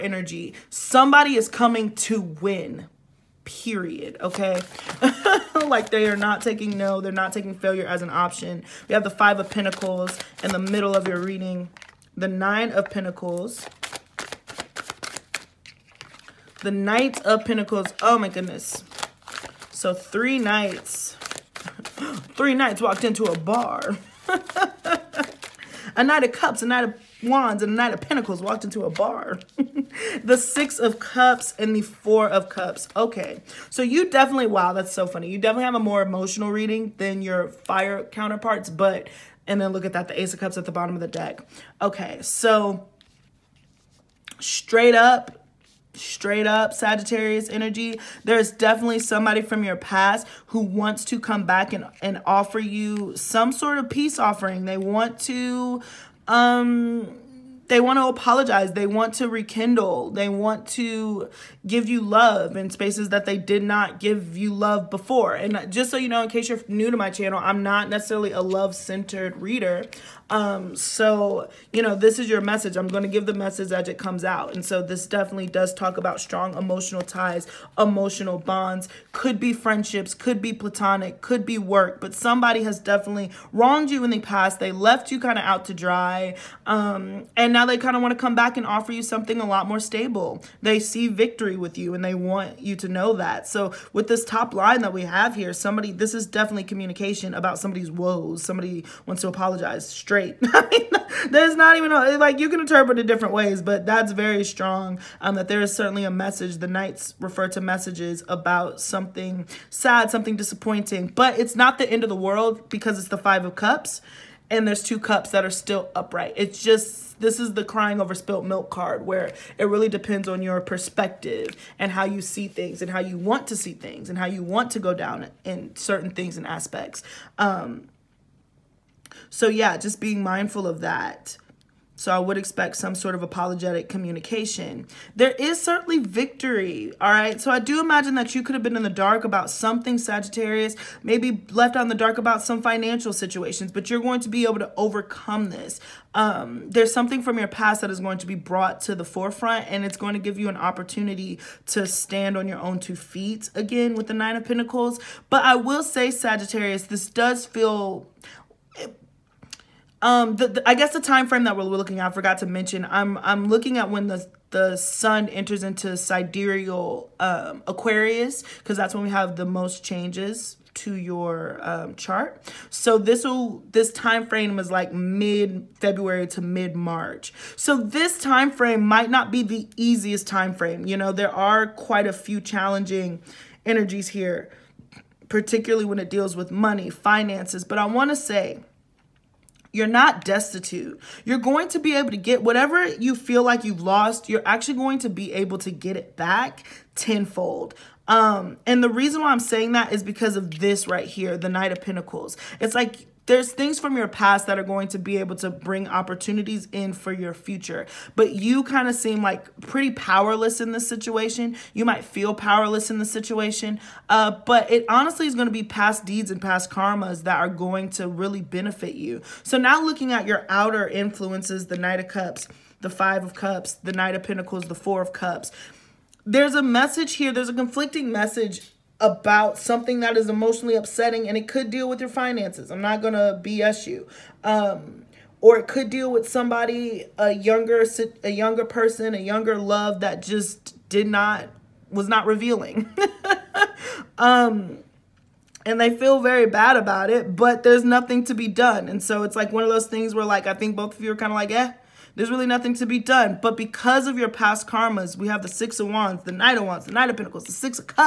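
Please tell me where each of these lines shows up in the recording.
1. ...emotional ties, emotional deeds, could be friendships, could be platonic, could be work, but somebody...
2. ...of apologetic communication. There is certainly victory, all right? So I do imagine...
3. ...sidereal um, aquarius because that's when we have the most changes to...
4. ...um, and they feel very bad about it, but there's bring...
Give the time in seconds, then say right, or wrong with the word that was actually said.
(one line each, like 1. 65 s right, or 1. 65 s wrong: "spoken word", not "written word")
1. 76 s wrong: "bonds", not "deeds"
2. 133 s right
3. 165 s right
4. 244 s wrong: "nothing", not "bring".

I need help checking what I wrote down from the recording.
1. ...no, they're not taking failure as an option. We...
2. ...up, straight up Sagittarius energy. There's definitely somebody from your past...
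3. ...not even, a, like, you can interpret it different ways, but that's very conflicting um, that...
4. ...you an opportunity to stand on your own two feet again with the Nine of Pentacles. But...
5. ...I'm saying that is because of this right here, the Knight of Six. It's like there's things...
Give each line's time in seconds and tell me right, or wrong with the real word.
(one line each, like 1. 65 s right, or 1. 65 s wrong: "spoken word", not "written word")
1. 6 s right
2. 44 s right
3. 101 s wrong: "strong", not "conflicting"
4. 150 s right
5. 199 s wrong: "Pentacles", not "Six".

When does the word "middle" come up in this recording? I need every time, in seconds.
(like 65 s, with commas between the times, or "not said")
10 s.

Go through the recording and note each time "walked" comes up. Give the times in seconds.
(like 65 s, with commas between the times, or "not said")
22 s, 28 s.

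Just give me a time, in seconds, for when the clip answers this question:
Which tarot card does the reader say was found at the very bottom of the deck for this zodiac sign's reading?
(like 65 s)
40 s.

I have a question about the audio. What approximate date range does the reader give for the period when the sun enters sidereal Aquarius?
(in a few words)
mid February to mid March.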